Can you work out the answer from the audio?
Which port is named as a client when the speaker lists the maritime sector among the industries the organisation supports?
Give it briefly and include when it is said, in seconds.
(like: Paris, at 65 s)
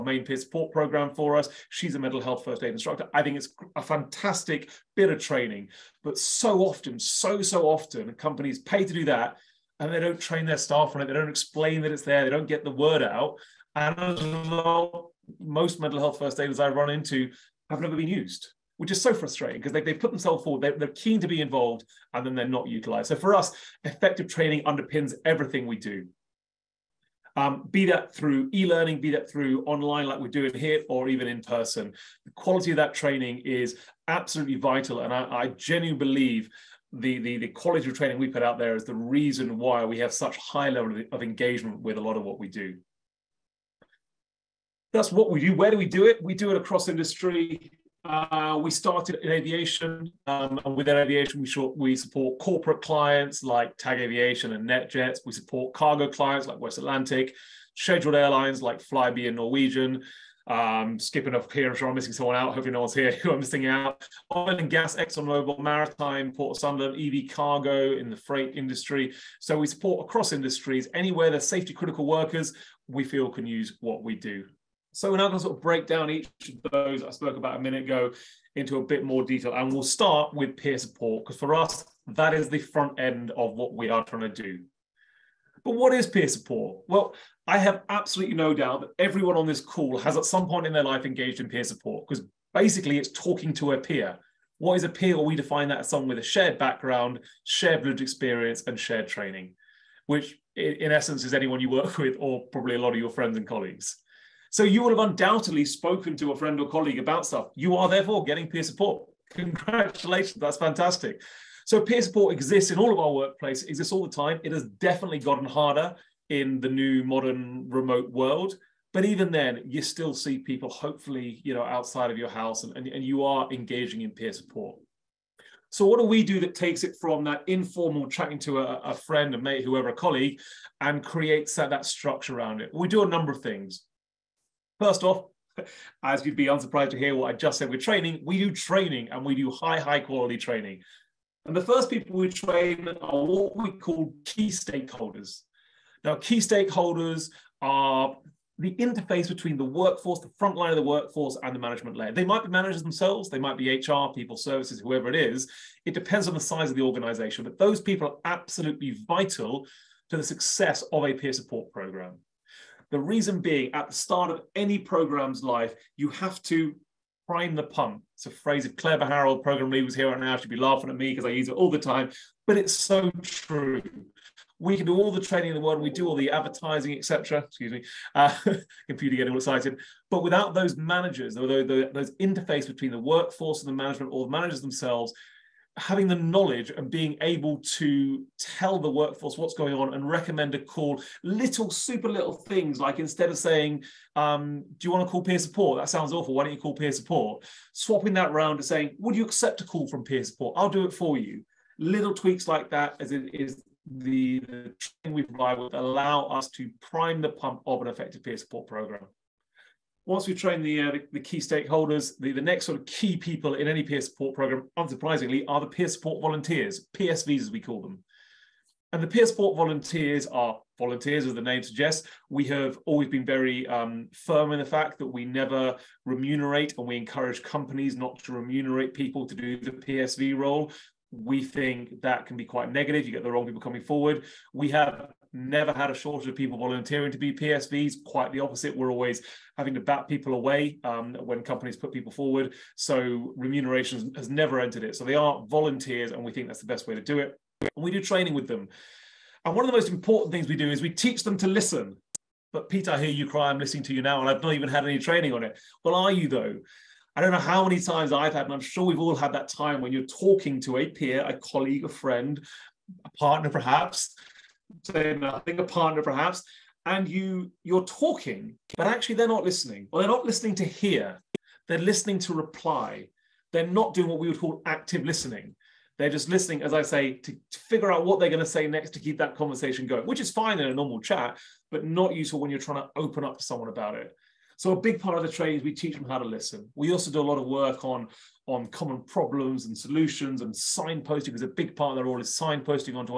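Port of Sunderland, at 66 s.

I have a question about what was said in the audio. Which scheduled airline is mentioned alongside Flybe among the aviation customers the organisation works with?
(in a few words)
Norwegian.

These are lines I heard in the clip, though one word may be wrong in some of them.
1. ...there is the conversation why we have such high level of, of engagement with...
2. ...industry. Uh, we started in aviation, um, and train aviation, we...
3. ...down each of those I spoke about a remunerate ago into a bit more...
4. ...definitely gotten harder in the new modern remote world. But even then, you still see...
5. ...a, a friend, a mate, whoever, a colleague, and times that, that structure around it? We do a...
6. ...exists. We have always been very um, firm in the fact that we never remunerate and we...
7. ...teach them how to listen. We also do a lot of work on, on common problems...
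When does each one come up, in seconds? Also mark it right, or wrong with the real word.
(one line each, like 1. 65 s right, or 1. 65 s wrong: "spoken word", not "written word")
1. 38 s wrong: "reason", not "conversation"
2. 46 s wrong: "within", not "train"
3. 75 s wrong: "minute", not "remunerate"
4. 114 s right
5. 128 s wrong: "creates", not "times"
6. 221 s wrong: "suggests", not "exists"
7. 285 s right.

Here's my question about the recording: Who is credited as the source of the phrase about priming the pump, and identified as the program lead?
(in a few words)
Claire Harold.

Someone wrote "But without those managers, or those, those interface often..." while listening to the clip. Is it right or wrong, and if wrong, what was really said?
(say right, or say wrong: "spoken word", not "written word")
wrong: "between", not "often".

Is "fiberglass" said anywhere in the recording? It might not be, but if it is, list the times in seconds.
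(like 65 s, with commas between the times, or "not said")
not said.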